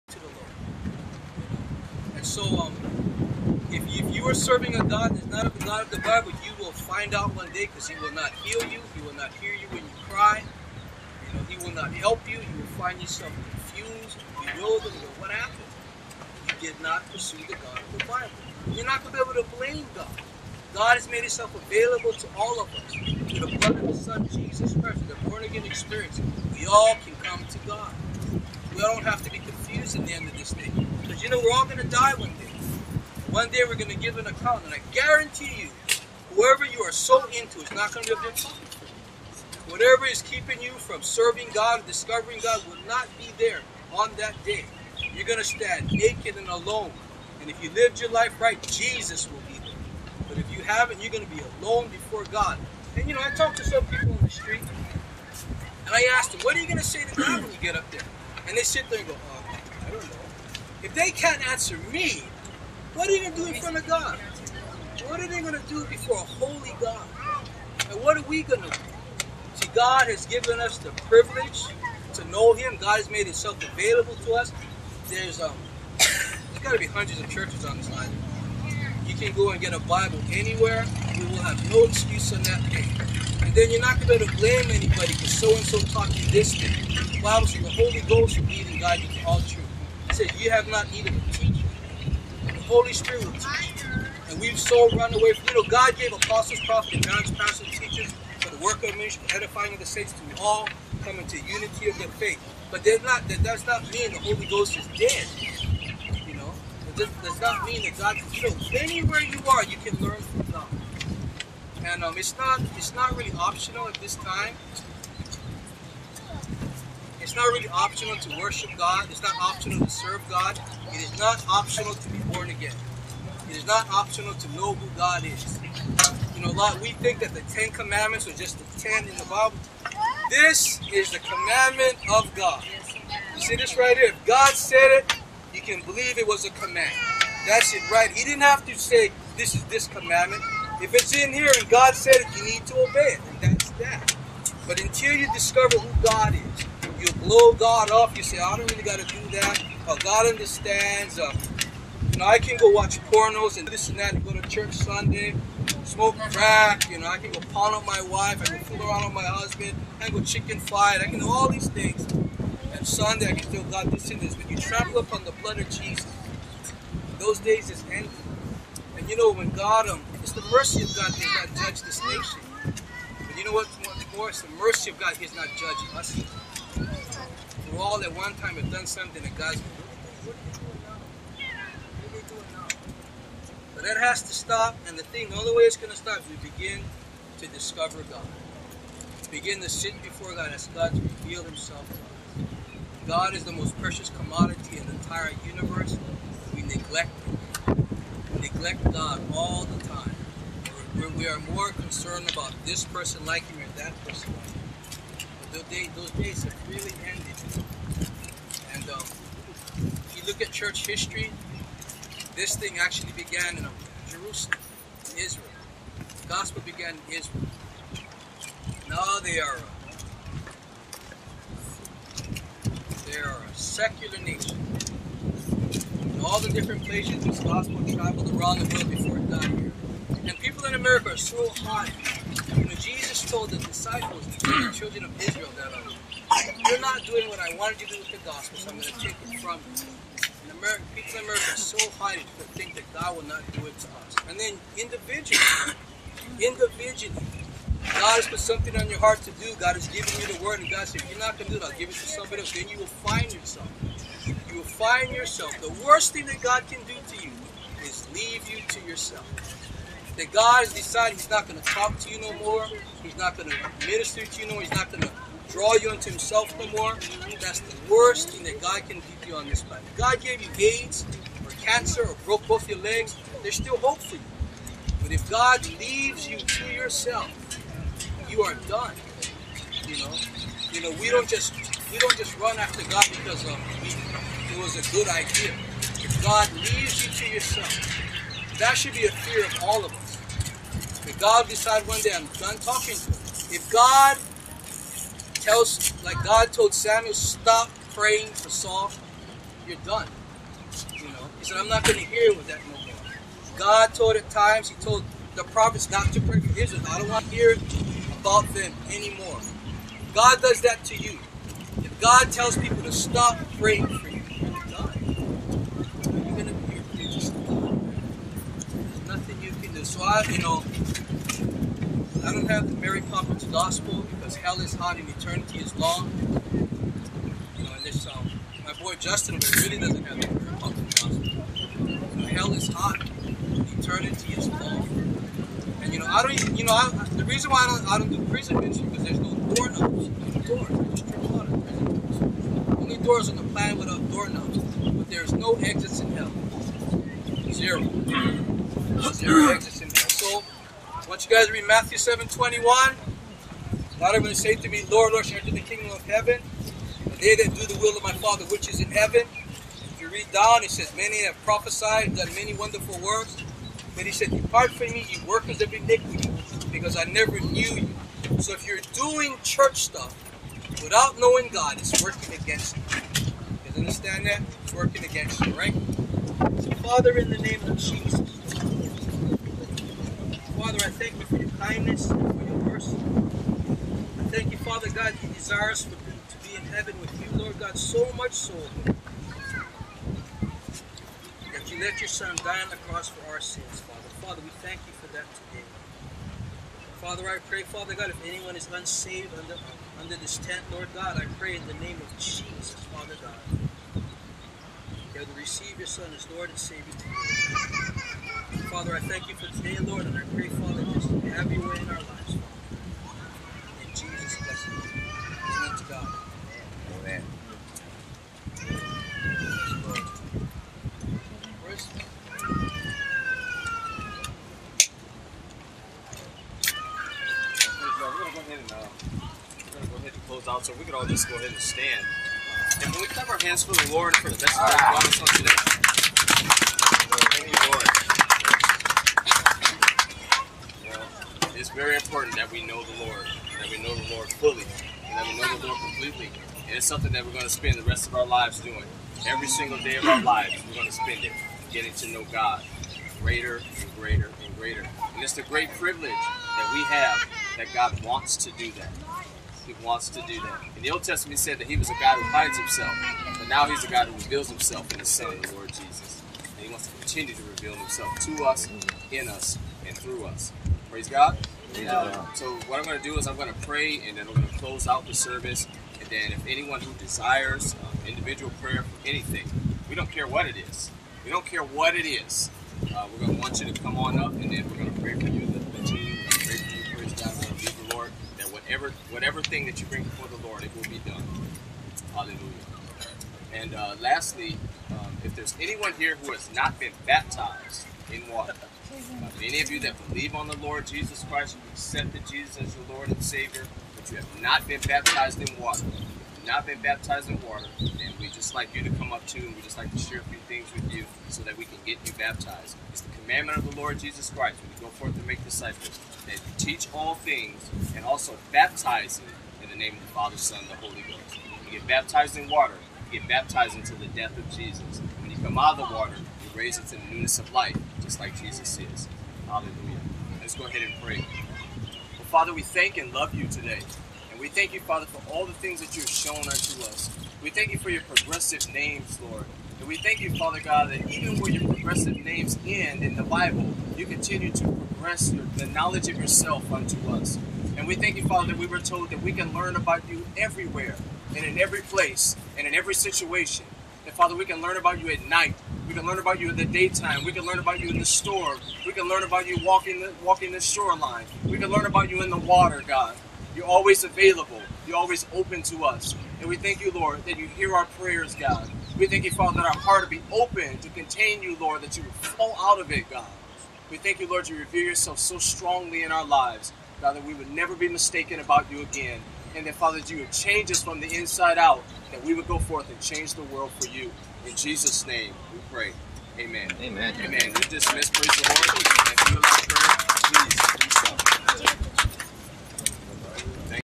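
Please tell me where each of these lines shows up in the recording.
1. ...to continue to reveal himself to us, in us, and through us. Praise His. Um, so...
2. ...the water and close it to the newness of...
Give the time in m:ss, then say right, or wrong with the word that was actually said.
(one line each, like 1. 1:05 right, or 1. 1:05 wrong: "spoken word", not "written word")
1. 7:46 wrong: "God", not "His"
2. 8:45 wrong: "raise", not "close".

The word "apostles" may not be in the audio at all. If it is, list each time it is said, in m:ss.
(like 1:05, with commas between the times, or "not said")
1:36.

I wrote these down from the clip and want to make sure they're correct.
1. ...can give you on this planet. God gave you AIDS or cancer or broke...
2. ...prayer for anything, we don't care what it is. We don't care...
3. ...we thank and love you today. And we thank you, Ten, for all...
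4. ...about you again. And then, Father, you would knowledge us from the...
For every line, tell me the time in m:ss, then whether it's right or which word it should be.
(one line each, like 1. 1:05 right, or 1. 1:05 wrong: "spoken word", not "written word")
1. 4:28 right
2. 7:58 right
3. 8:52 wrong: "Father", not "Ten"
4. 9:38 wrong: "change", not "knowledge".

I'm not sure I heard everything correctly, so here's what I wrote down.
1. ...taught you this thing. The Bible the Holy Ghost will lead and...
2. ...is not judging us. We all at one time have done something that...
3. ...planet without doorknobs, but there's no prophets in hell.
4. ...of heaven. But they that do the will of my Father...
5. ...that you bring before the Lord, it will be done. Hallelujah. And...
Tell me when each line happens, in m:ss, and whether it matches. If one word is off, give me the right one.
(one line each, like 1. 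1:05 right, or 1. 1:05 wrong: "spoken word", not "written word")
1. 1:25 right
2. 2:55 right
3. 5:43 wrong: "exits", not "prophets"
4. 5:55 right
5. 8:09 right.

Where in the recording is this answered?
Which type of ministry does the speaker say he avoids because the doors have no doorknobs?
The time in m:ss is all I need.
5:38.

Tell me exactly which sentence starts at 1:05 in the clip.
What are they going to do before a holy God?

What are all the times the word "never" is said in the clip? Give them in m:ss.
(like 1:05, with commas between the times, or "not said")
6:07, 9:37.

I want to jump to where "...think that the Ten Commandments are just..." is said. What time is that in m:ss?
2:06.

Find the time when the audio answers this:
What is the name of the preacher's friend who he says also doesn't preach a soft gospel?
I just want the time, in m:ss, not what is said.
5:28.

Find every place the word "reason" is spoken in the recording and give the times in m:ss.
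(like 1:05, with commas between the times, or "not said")
5:37.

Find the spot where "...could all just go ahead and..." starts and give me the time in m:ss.
7:10.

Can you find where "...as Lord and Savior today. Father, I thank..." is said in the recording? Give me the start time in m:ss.
6:46.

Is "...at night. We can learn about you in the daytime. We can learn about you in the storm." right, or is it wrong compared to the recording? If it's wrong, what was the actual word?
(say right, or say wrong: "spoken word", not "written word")
right.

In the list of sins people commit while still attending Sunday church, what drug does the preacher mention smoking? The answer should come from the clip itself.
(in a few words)
Crack.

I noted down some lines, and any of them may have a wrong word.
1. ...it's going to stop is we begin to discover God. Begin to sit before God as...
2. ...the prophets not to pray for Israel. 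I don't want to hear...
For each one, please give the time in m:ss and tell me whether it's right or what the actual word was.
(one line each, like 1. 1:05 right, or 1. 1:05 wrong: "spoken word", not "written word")
1. 3:05 right
2. 5:05 right.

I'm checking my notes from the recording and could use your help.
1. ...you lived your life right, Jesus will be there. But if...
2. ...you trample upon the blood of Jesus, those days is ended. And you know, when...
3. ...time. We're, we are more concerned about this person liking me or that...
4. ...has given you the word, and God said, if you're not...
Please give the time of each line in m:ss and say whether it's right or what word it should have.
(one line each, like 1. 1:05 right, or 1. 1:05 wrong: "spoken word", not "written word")
1. 0:47 right
2. 2:44 right
3. 3:19 right
4. 4:09 right.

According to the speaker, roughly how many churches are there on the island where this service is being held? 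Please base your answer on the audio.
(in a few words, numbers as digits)
Hundreds.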